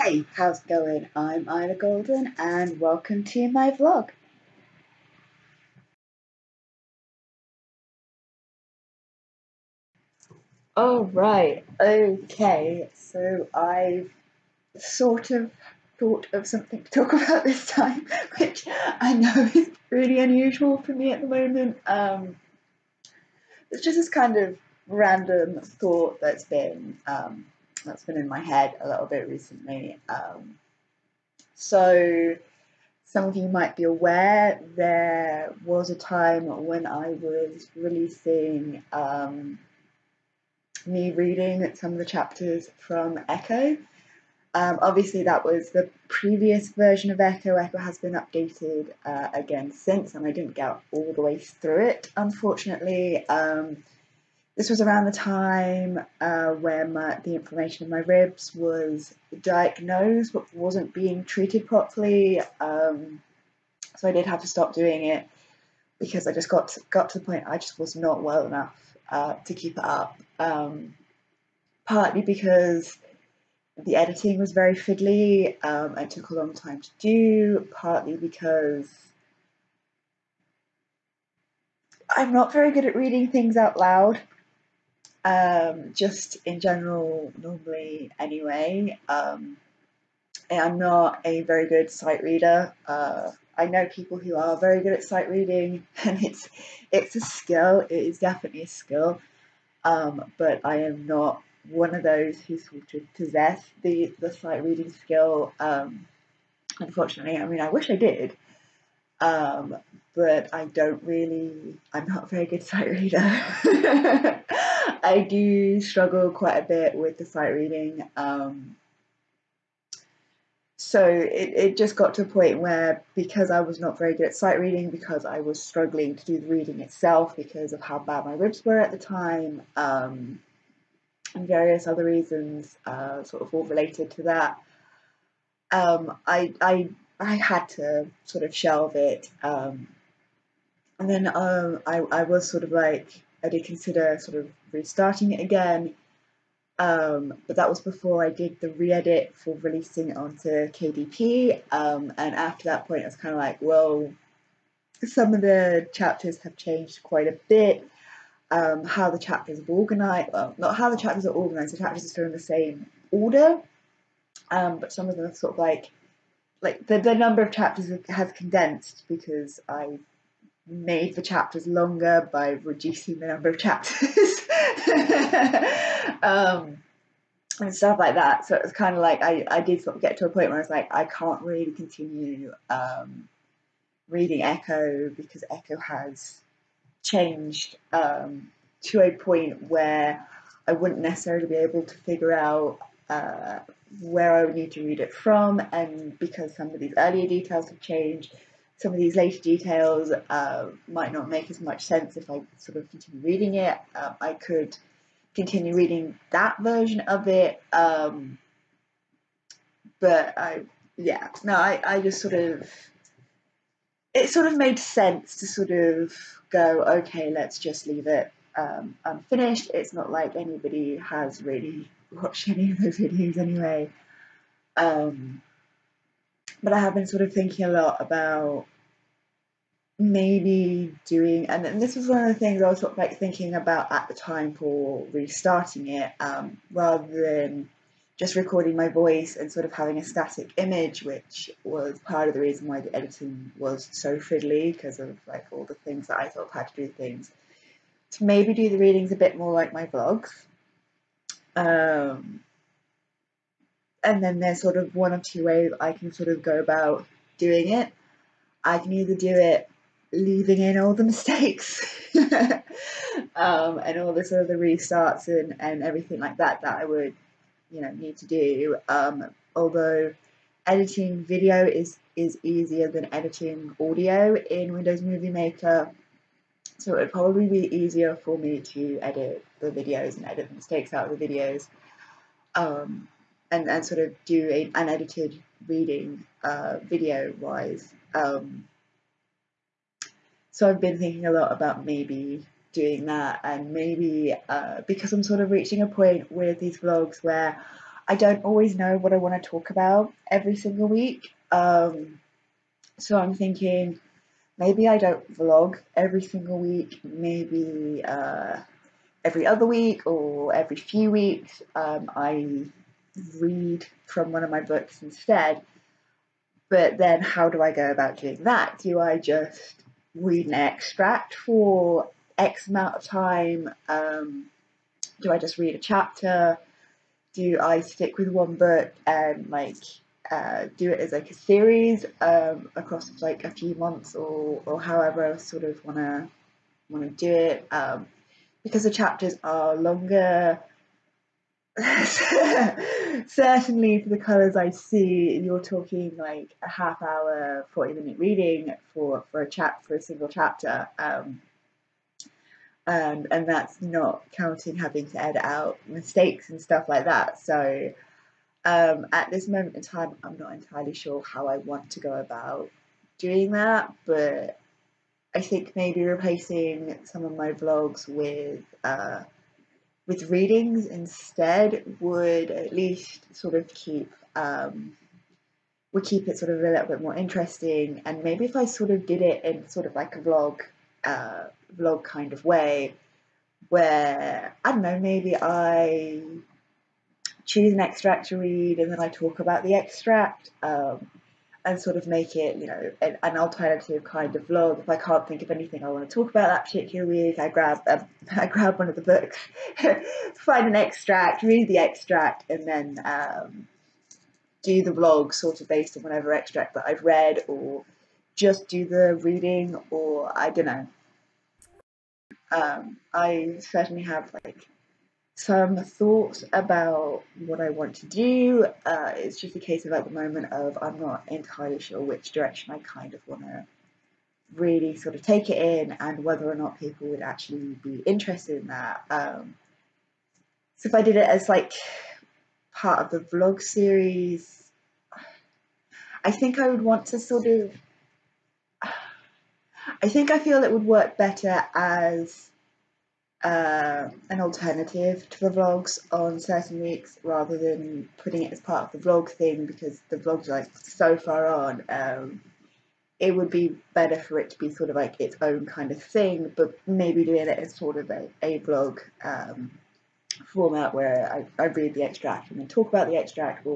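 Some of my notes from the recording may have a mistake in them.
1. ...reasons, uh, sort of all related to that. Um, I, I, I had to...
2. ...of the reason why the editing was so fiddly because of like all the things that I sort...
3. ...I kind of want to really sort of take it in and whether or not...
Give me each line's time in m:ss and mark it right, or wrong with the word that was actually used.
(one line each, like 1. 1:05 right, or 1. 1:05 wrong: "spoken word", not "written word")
1. 2:12 right
2. 4:02 right
3. 7:02 right.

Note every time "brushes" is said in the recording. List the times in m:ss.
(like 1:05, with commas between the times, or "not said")
not said.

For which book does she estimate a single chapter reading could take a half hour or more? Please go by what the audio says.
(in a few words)
The Colours I See.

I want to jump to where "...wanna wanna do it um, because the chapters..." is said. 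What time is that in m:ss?
5:35.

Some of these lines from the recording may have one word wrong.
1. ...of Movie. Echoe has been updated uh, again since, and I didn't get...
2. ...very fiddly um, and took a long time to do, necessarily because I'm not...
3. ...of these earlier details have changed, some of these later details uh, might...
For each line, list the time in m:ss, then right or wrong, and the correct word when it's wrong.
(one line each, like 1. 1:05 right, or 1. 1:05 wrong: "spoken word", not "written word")
1. 0:47 wrong: "Echoe", not "Movie"
2. 1:14 wrong: "partly", not "necessarily"
3. 3:16 right.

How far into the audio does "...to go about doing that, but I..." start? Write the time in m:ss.
6:01.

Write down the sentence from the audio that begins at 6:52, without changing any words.
Um, I certainly have like some thoughts about what I want to do.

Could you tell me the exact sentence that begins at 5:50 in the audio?
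Um, um, and that's not counting having to edit out mistakes and stuff like that.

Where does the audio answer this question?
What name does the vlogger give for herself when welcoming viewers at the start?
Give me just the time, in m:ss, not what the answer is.
0:01.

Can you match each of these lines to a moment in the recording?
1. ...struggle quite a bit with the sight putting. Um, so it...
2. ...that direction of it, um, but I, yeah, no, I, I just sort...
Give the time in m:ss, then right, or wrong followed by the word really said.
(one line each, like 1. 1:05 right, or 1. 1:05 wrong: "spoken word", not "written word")
1. 1:55 wrong: "reading", not "putting"
2. 3:26 wrong: "version", not "direction".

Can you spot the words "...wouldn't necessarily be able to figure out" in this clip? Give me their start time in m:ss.
3:10.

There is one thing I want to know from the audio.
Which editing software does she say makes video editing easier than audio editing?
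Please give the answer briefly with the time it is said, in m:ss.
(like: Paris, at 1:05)
Windows Movie Maker, at 4:34.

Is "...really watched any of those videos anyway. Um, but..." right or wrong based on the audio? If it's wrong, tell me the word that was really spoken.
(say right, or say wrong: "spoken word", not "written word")
right.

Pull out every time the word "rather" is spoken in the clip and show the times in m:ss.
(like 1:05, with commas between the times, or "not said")
3:56, 7:27.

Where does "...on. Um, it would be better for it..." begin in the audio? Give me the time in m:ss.
7:31.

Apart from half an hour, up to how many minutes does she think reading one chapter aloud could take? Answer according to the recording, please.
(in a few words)
40 minutes.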